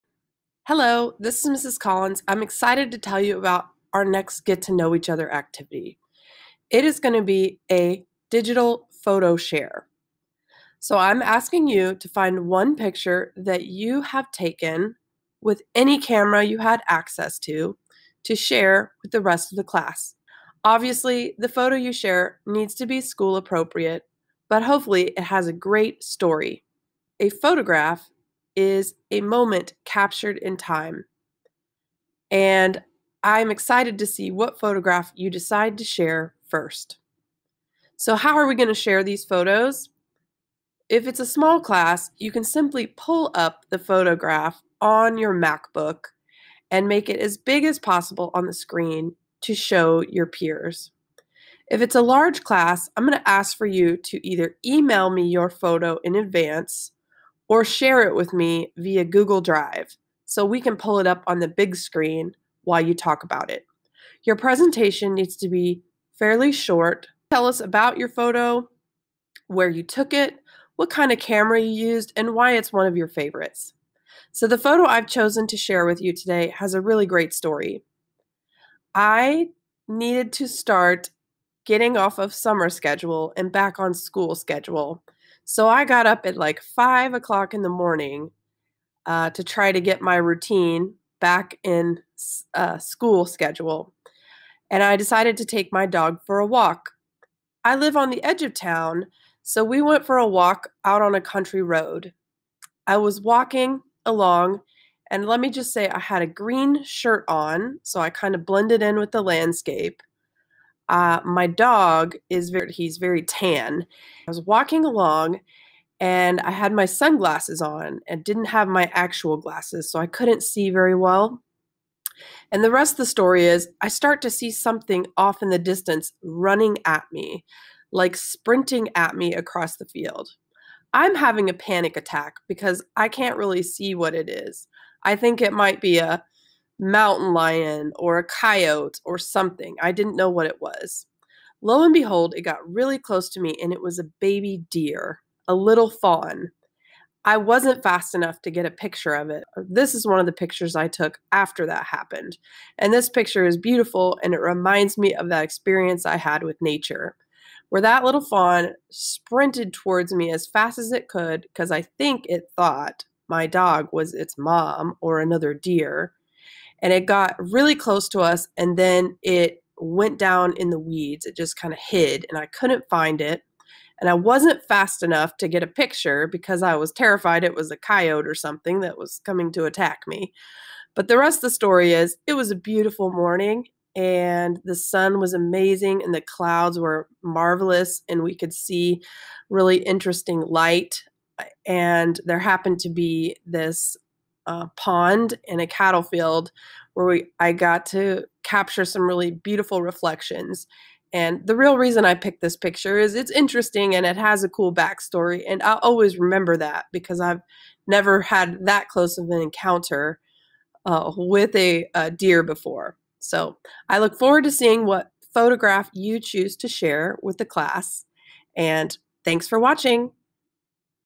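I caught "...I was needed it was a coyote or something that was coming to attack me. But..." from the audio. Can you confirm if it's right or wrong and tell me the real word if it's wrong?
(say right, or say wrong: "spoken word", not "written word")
wrong: "terrified", not "needed".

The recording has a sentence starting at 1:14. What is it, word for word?
So, the photo I've chosen to share with you today has a really great story.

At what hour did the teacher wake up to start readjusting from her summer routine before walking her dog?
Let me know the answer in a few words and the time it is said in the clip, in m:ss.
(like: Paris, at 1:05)
5 o'clock, at 1:26.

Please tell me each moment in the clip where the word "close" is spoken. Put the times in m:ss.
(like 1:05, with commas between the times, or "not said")
2:22, 2:47, 3:28.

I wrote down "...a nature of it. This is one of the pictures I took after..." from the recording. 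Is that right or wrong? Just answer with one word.
wrong.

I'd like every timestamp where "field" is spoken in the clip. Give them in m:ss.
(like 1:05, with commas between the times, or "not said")
2:09, 3:16.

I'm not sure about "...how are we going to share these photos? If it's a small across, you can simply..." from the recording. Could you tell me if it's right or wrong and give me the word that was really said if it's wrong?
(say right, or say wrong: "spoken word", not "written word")
wrong: "class", not "across".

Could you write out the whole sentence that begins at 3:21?
And the real reason I picked this picture is it's interesting and it has a cool backstory.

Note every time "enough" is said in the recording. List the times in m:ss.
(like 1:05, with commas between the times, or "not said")
2:28, 2:55.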